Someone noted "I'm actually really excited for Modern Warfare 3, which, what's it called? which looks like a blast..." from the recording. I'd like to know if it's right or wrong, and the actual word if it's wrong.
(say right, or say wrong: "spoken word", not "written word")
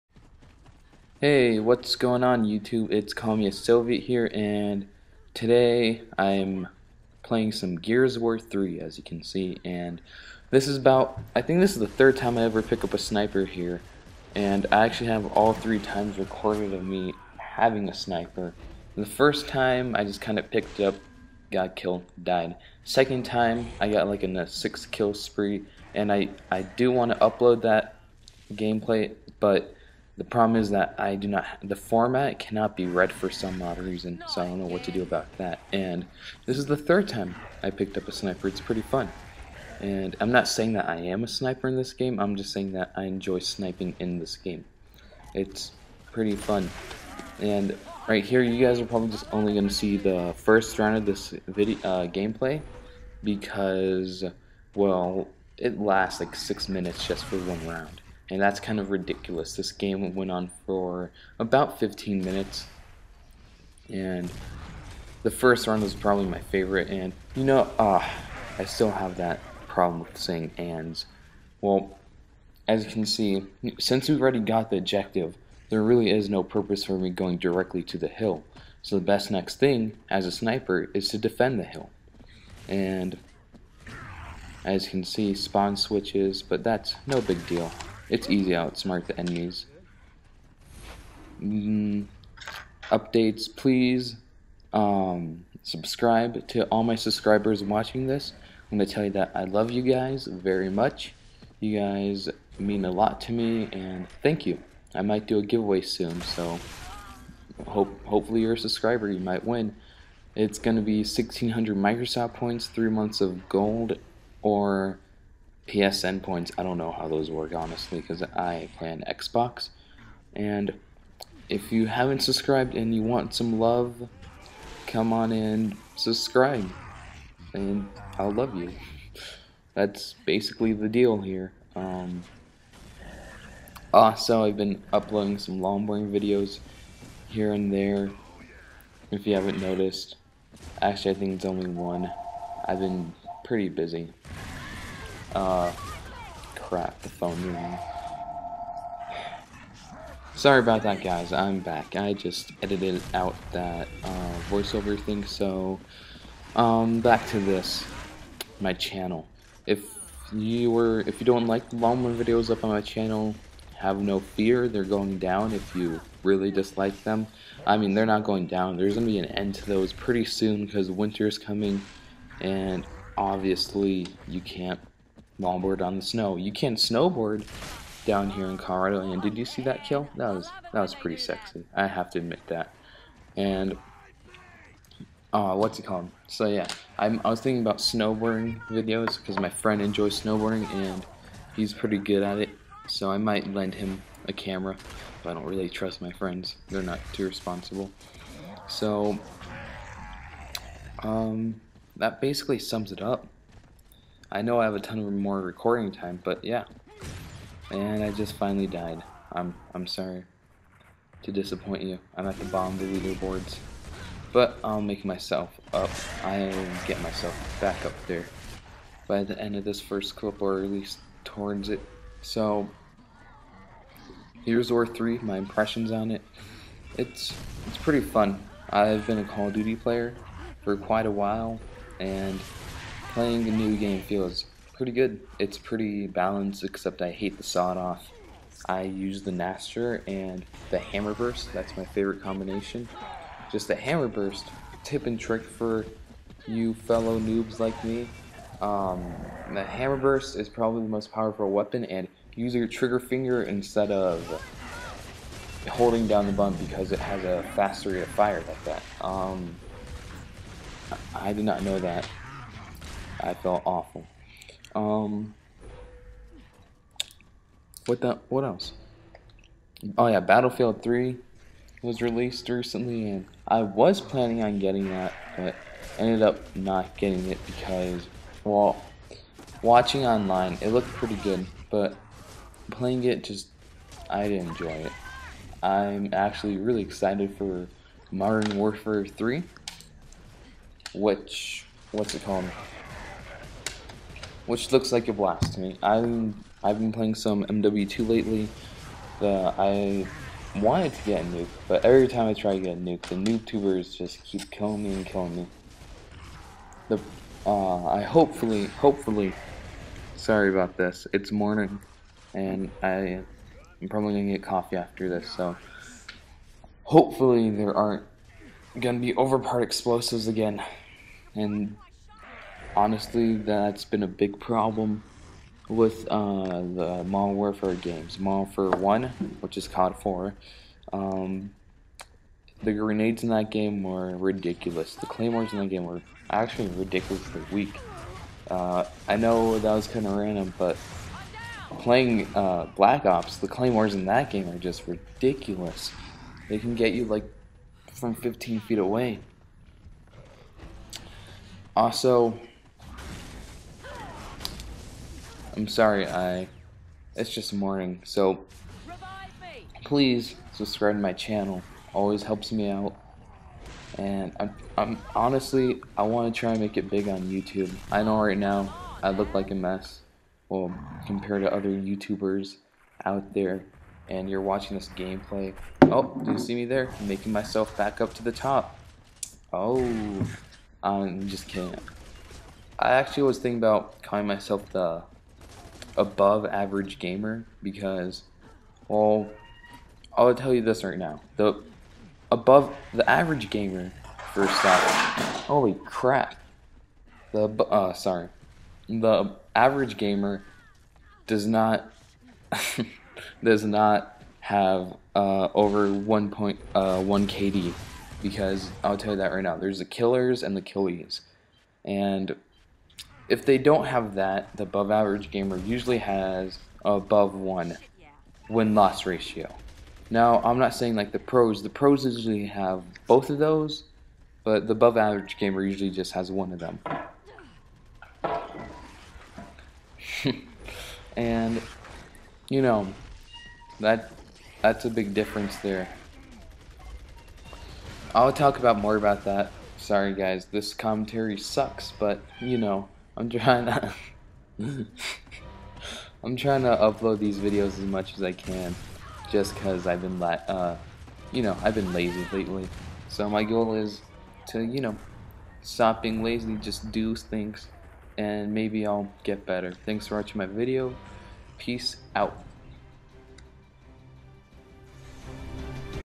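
right.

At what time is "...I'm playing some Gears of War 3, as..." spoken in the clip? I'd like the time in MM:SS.
00:06.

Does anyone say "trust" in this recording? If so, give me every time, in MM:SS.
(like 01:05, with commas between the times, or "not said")
03:15.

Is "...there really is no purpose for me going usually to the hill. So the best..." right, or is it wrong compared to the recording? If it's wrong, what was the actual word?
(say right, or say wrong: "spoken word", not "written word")
wrong: "directly", not "usually".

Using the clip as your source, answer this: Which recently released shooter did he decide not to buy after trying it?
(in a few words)
Battlefield 3.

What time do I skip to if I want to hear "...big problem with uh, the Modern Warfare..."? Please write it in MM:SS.
05:24.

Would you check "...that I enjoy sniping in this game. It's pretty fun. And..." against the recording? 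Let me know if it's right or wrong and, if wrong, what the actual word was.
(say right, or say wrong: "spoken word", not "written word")
right.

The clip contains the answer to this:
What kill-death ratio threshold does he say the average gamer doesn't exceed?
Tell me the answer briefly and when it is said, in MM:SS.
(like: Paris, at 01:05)
1.1, at 06:45.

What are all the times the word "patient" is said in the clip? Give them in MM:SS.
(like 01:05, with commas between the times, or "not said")
not said.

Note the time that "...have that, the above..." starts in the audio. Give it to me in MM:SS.
06:53.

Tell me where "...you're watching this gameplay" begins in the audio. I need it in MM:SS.
06:14.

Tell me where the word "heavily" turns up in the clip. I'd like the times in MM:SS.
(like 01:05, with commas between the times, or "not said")
not said.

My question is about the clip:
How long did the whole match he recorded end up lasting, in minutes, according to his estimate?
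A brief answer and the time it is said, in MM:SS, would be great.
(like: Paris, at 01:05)
15 minutes, at 01:01.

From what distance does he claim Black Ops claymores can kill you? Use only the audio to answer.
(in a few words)
15 feet.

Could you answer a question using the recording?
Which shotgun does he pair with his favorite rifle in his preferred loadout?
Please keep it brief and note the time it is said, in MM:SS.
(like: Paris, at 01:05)
Gnasher, at 03:59.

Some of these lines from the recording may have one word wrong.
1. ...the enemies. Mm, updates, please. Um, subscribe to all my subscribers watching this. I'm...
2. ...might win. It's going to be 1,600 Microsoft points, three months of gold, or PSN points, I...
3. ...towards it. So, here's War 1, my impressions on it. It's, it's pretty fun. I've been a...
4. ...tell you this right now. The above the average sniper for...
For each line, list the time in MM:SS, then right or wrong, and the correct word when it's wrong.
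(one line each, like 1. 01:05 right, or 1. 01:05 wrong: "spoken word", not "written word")
1. 01:29 right
2. 01:49 right
3. 03:41 wrong: "3", not "1"
4. 06:30 wrong: "gamer", not "sniper".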